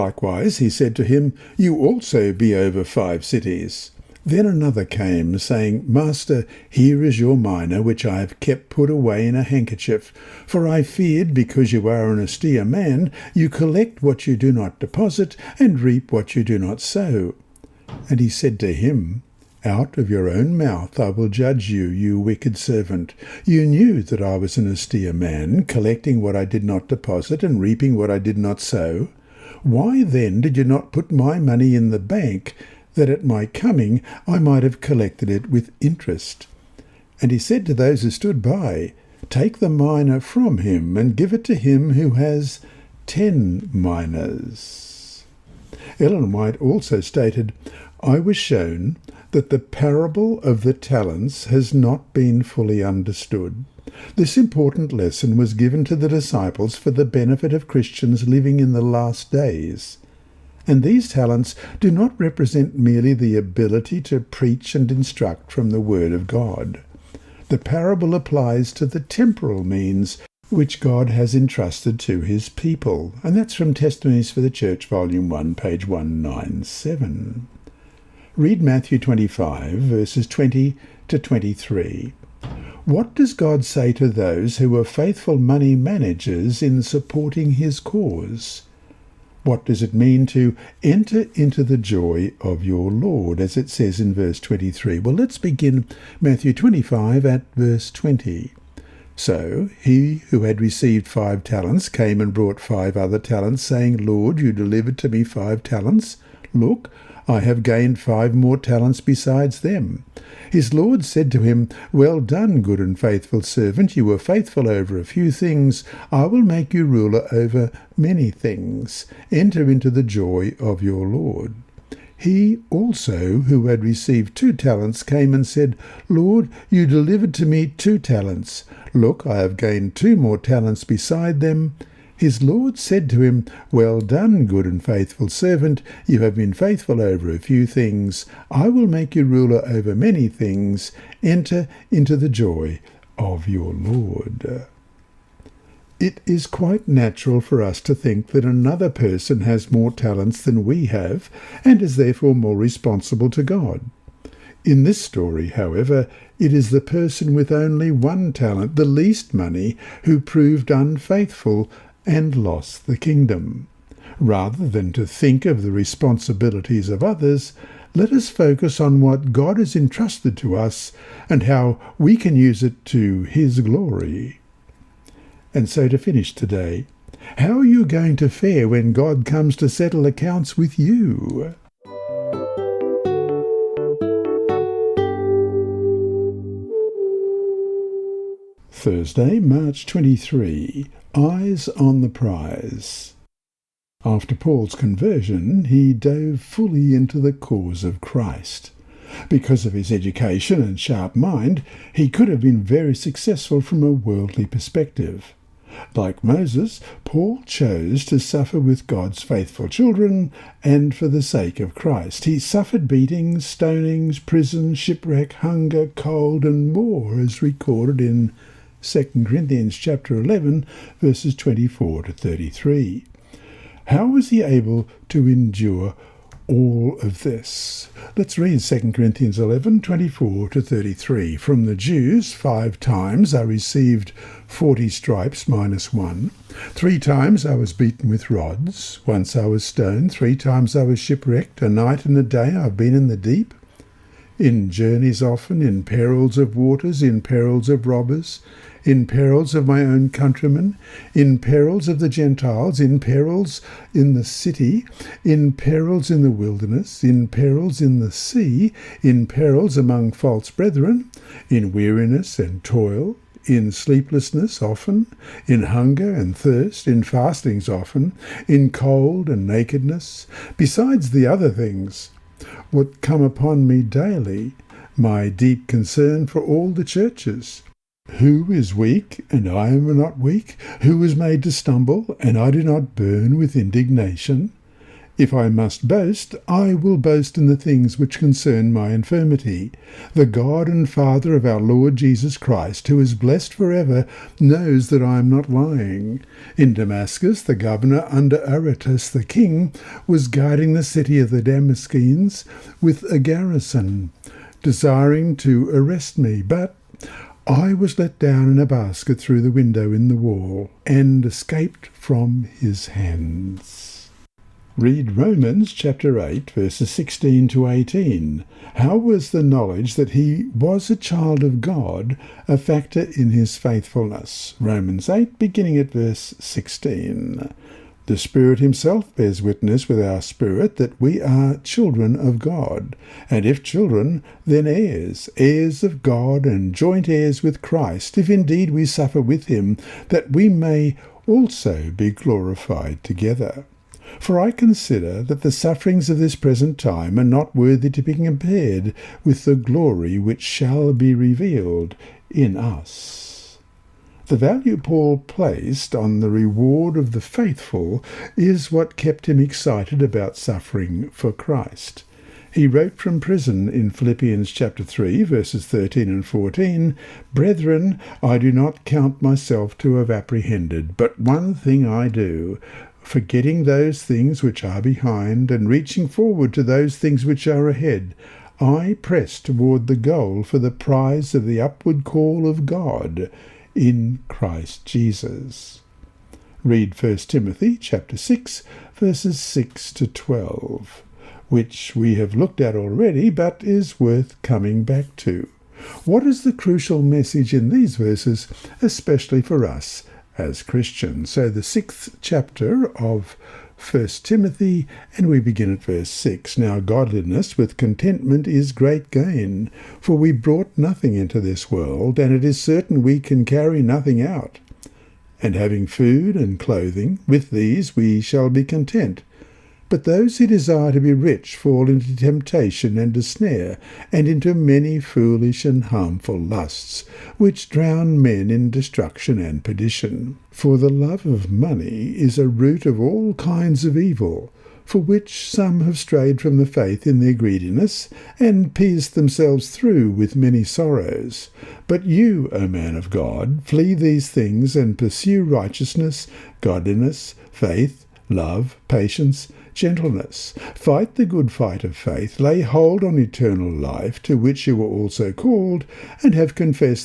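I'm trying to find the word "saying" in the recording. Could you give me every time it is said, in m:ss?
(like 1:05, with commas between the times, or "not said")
0:05, 1:43.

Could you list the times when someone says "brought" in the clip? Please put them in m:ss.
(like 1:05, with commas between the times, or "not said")
1:42, 6:50.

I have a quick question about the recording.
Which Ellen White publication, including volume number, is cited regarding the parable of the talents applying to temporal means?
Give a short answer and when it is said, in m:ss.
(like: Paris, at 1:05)
Testimonies for the Church, Volume 1, at 1:13.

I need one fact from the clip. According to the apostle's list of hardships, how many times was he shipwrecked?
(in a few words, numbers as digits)
3.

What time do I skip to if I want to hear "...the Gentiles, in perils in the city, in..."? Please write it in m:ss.
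4:11.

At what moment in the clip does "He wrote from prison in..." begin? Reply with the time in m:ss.
6:02.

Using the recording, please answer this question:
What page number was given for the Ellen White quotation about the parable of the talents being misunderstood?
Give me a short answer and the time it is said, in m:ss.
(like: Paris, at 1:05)
197, at 1:15.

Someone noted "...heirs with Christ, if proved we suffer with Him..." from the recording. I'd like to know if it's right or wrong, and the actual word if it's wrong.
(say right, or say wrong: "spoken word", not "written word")
wrong: "indeed", not "proved".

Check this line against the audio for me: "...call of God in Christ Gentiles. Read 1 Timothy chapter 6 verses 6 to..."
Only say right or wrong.
wrong.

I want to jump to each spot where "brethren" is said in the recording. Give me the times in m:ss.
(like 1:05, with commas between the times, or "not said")
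4:20, 6:07.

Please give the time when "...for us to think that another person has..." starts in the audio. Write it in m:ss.
2:27.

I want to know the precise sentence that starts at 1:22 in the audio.
What does God say to those who are faithful money managers in supporting his cause?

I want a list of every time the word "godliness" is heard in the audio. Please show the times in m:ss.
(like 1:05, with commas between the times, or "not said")
6:46, 7:26.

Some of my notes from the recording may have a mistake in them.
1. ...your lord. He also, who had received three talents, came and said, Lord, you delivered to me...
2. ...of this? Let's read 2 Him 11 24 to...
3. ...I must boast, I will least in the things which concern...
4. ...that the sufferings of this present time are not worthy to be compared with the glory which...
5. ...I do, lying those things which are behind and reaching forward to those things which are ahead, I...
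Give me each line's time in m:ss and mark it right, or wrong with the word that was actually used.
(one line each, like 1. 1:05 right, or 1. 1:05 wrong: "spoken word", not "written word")
1. 2:00 wrong: "two", not "three"
2. 3:47 wrong: "Corinthians", not "Him"
3. 4:45 wrong: "boast", not "least"
4. 5:45 right
5. 6:11 wrong: "forgetting", not "lying".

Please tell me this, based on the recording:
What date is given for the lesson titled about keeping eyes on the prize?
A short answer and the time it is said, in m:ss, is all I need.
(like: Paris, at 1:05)
Thursday, March 23, at 3:08.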